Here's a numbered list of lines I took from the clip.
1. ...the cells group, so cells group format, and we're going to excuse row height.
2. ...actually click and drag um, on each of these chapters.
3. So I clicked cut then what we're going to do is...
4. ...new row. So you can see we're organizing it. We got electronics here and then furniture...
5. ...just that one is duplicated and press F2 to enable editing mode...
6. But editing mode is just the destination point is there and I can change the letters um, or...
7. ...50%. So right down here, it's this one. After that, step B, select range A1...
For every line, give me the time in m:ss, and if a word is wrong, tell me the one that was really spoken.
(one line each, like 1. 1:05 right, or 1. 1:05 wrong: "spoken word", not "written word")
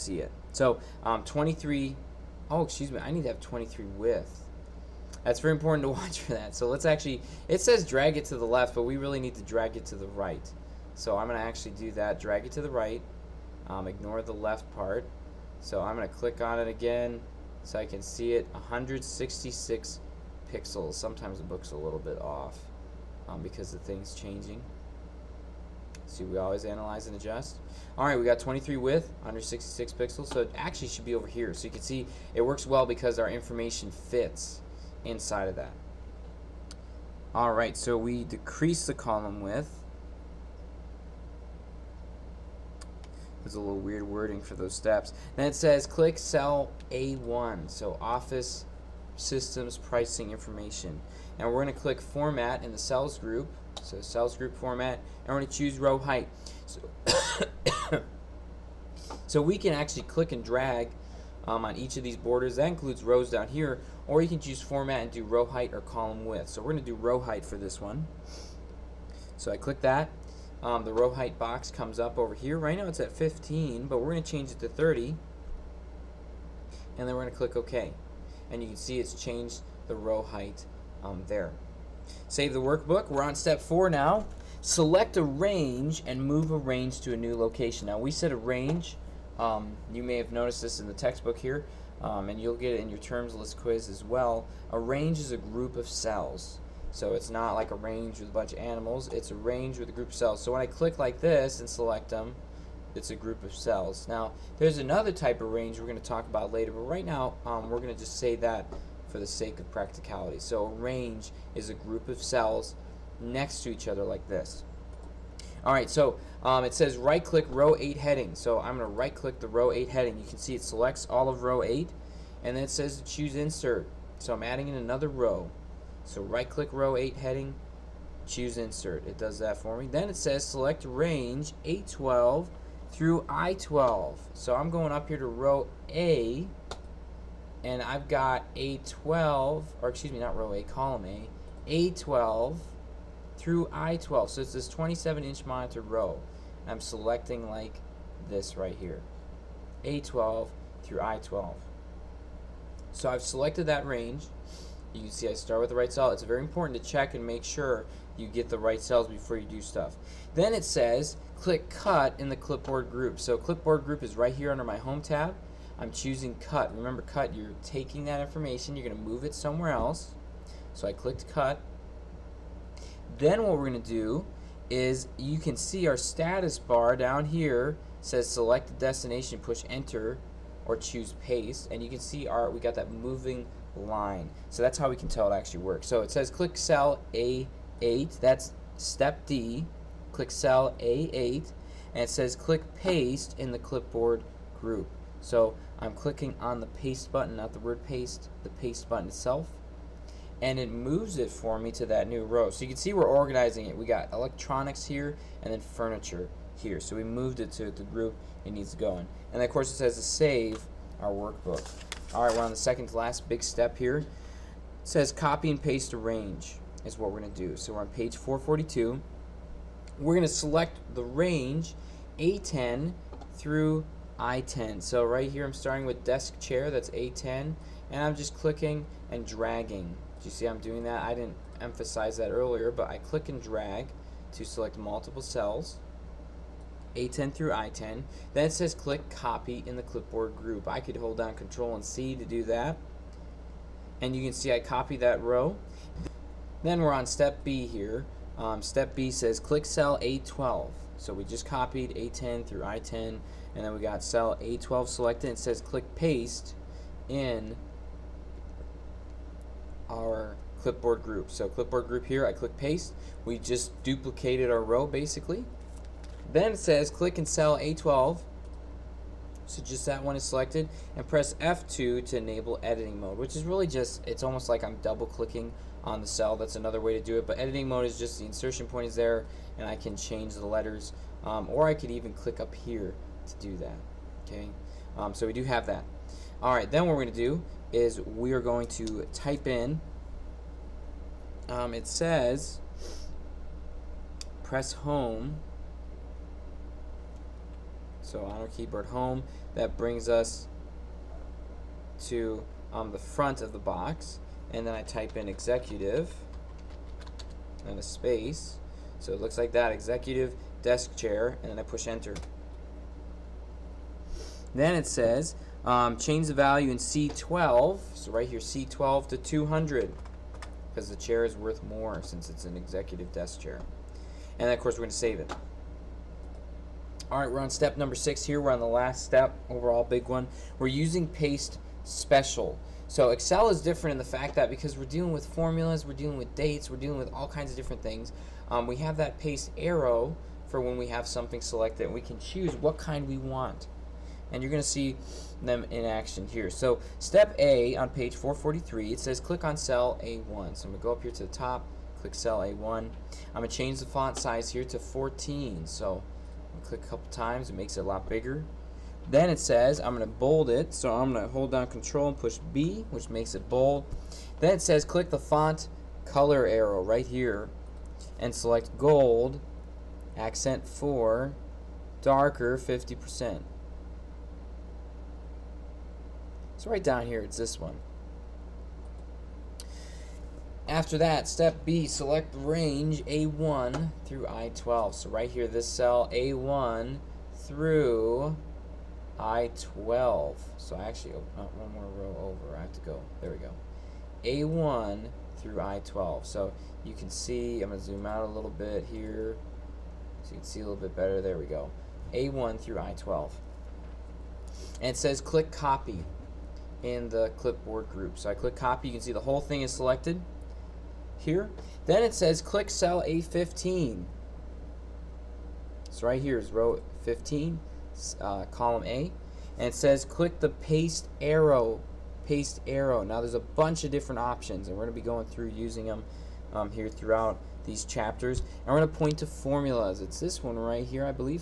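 1. 0:52 wrong: "choose", not "excuse"
2. 0:59 wrong: "borders", not "chapters"
3. 2:50 right
4. 3:22 right
5. 4:29 wrong: "selected", not "duplicated"
6. 4:37 wrong: "insertion", not "destination"
7. 6:12 right.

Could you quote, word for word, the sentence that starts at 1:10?
Um, the row height box comes up over here.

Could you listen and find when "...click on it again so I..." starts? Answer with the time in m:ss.
0:16.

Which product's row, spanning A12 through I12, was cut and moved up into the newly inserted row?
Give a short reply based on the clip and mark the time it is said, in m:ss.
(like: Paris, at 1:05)
27 inch monitor, at 2:24.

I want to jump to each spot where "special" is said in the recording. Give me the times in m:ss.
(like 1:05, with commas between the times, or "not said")
5:31.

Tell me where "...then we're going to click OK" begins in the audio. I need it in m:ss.
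1:17.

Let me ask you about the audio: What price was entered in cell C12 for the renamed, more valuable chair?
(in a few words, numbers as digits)
200.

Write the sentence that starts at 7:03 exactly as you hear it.
Now there's a bunch of different options and we're going to be going through using them um, here throughout these chapters.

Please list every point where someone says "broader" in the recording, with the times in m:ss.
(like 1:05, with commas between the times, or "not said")
not said.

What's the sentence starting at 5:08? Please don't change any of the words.
So it looks like that, executive desk chair, and then I push enter.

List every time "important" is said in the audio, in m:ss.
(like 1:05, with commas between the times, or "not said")
0:05, 2:36.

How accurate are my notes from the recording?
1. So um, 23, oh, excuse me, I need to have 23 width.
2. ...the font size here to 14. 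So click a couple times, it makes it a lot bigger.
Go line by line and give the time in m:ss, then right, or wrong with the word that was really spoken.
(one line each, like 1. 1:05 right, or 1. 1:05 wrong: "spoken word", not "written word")
1. 0:00 right
2. 5:53 right.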